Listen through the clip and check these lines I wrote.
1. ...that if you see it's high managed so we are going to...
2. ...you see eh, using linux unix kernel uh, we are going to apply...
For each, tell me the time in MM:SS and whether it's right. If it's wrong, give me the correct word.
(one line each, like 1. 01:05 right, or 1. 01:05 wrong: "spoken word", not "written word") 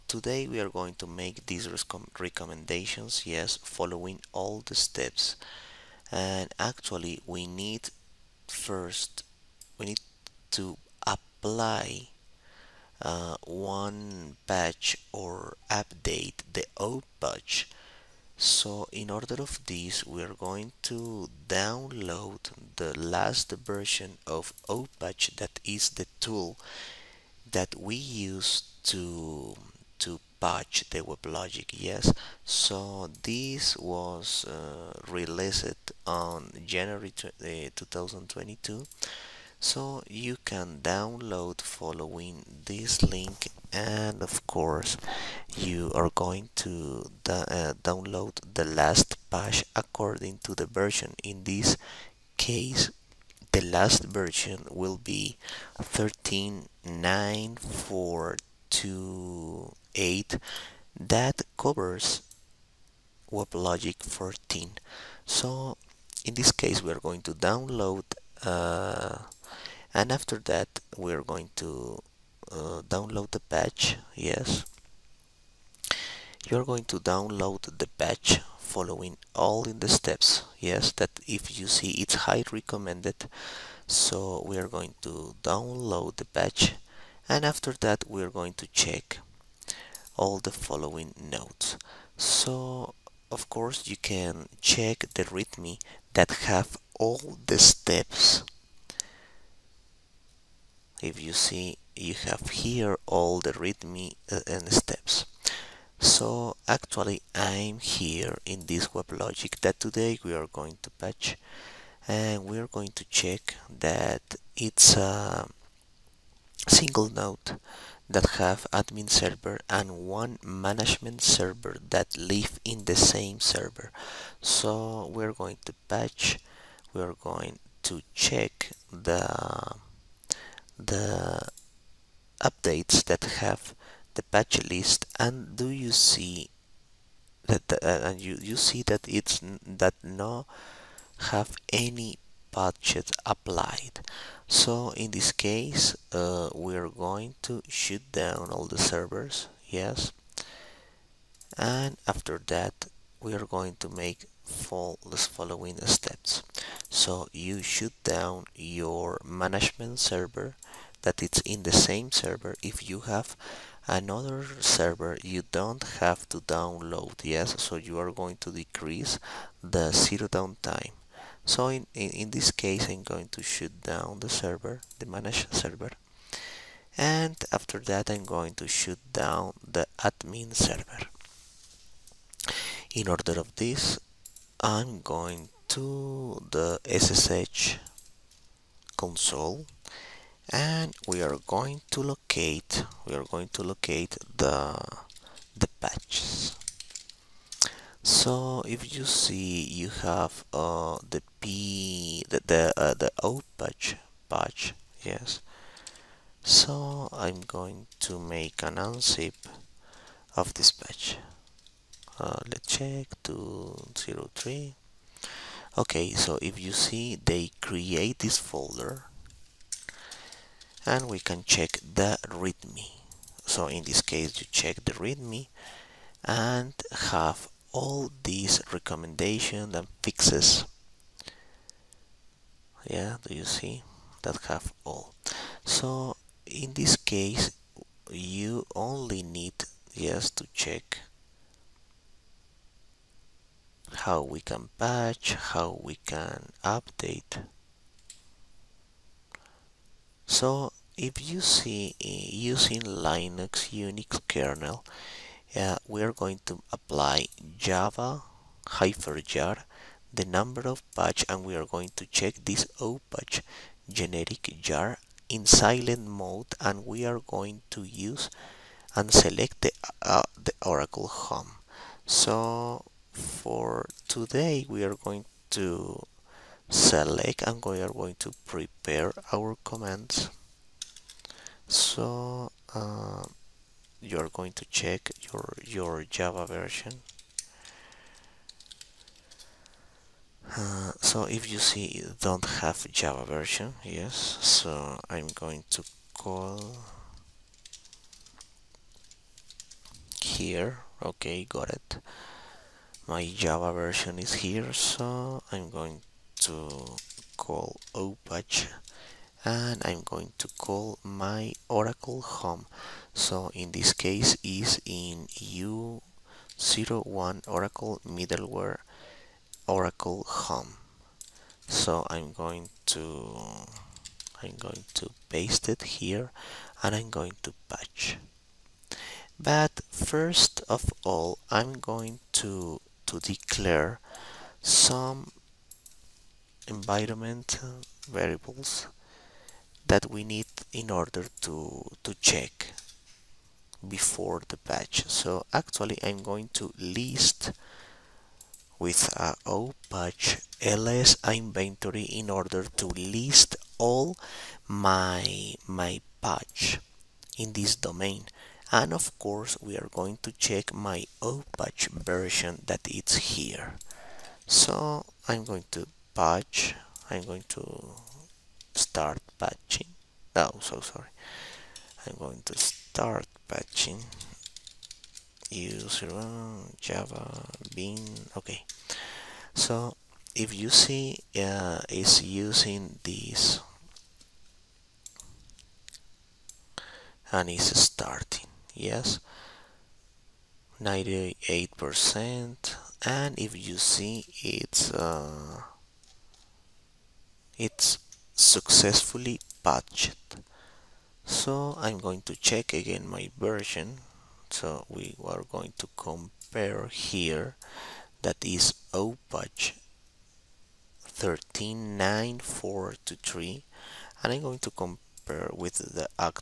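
1. 01:20 wrong: "recommended", not "managed"
2. 04:11 right.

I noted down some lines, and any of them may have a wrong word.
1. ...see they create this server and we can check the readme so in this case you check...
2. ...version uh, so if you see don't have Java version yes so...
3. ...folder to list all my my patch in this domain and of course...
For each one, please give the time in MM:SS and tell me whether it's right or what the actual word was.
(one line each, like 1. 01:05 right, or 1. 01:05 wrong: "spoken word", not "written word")
1. 03:36 wrong: "folder", not "server"
2. 04:46 right
3. 05:52 wrong: "order", not "folder".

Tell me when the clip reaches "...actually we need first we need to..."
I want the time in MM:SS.
00:06.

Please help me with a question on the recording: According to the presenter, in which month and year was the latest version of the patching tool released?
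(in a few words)
January 2022.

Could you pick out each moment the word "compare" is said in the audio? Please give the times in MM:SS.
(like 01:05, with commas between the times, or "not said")
06:45, 06:54.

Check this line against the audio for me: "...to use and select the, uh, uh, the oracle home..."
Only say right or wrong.
right.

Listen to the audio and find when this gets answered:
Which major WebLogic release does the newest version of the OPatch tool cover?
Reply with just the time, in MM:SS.
01:03.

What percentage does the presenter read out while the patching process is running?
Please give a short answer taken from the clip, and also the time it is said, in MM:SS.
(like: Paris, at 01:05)
98%, at 06:30.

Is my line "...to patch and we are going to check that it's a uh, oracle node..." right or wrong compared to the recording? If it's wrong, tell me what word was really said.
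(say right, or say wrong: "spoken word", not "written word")
wrong: "single", not "oracle".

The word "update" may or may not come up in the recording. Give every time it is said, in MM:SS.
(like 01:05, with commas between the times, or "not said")
00:15, 02:12, 04:06.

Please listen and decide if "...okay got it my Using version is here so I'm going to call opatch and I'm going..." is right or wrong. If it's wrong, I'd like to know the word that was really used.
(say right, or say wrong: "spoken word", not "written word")
wrong: "Java", not "Using".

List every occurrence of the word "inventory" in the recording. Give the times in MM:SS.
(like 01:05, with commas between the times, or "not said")
05:51.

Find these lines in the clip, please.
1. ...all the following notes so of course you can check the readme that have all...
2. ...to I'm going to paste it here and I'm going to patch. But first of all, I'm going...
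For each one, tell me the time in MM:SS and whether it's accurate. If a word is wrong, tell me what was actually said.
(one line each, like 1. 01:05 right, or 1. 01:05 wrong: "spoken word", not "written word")
1. 01:30 right
2. 05:22 right.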